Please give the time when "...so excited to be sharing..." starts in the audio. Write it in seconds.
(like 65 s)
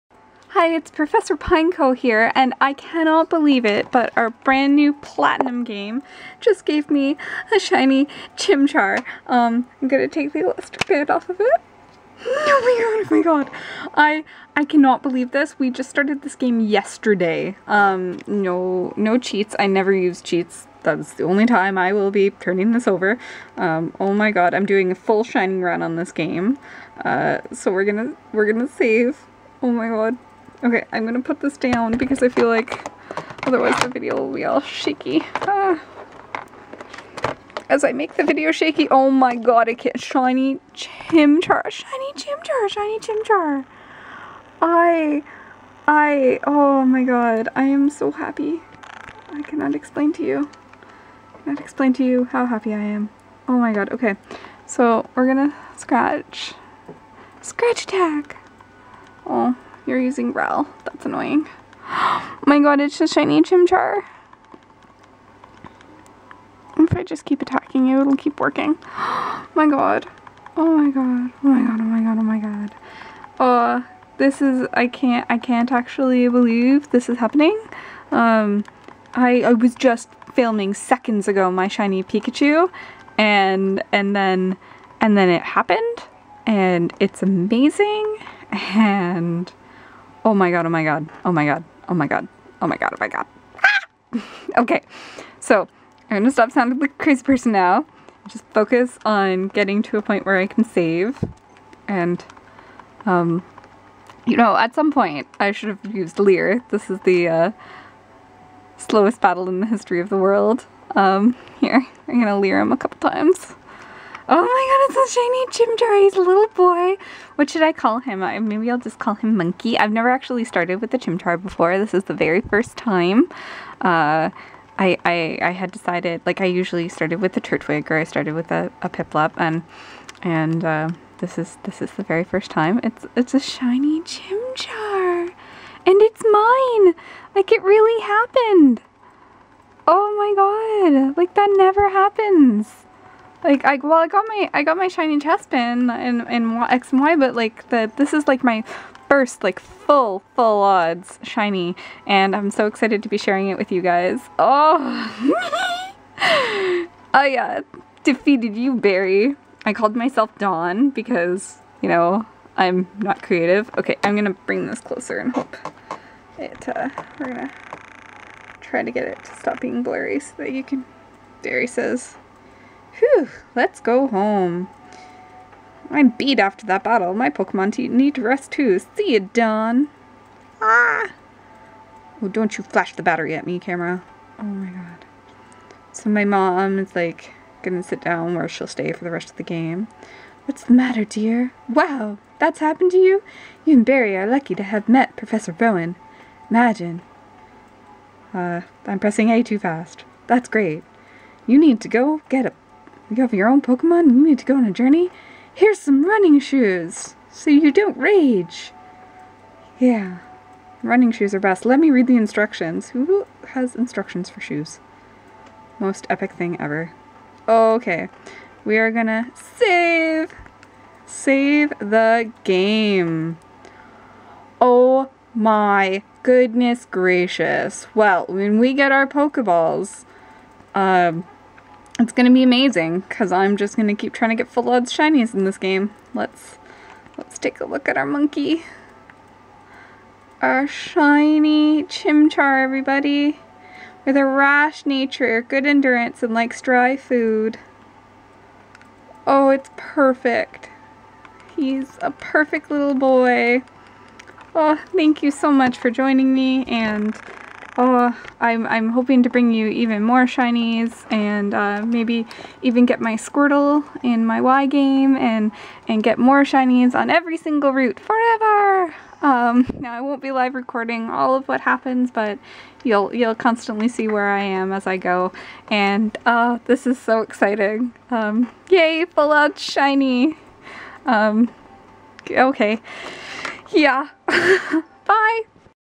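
152 s.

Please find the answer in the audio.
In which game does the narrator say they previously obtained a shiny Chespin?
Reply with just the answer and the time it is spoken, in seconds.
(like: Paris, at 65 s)
X and Y, at 146 s.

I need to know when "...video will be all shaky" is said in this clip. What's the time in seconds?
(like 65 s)
33 s.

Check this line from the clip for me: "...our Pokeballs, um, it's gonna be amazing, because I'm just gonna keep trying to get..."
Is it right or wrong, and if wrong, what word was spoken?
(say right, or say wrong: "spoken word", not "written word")
right.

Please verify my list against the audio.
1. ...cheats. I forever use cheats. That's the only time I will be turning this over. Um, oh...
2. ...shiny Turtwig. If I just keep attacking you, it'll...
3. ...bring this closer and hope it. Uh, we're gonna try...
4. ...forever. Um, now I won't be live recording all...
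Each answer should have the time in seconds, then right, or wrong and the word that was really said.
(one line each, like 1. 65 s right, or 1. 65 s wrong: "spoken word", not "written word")
1. 19 s wrong: "never", not "forever"
2. 63 s wrong: "Chimchar", not "Turtwig"
3. 164 s right
4. 267 s right.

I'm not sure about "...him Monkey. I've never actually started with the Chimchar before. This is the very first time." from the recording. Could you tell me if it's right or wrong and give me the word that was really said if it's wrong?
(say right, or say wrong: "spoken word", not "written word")
right.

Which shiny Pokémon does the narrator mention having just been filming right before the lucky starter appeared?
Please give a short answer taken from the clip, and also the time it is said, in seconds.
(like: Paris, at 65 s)
Pikachu, at 81 s.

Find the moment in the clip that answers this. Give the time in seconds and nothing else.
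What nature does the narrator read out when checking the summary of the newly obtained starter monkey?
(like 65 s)
244 s.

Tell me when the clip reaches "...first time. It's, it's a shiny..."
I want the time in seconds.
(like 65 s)
132 s.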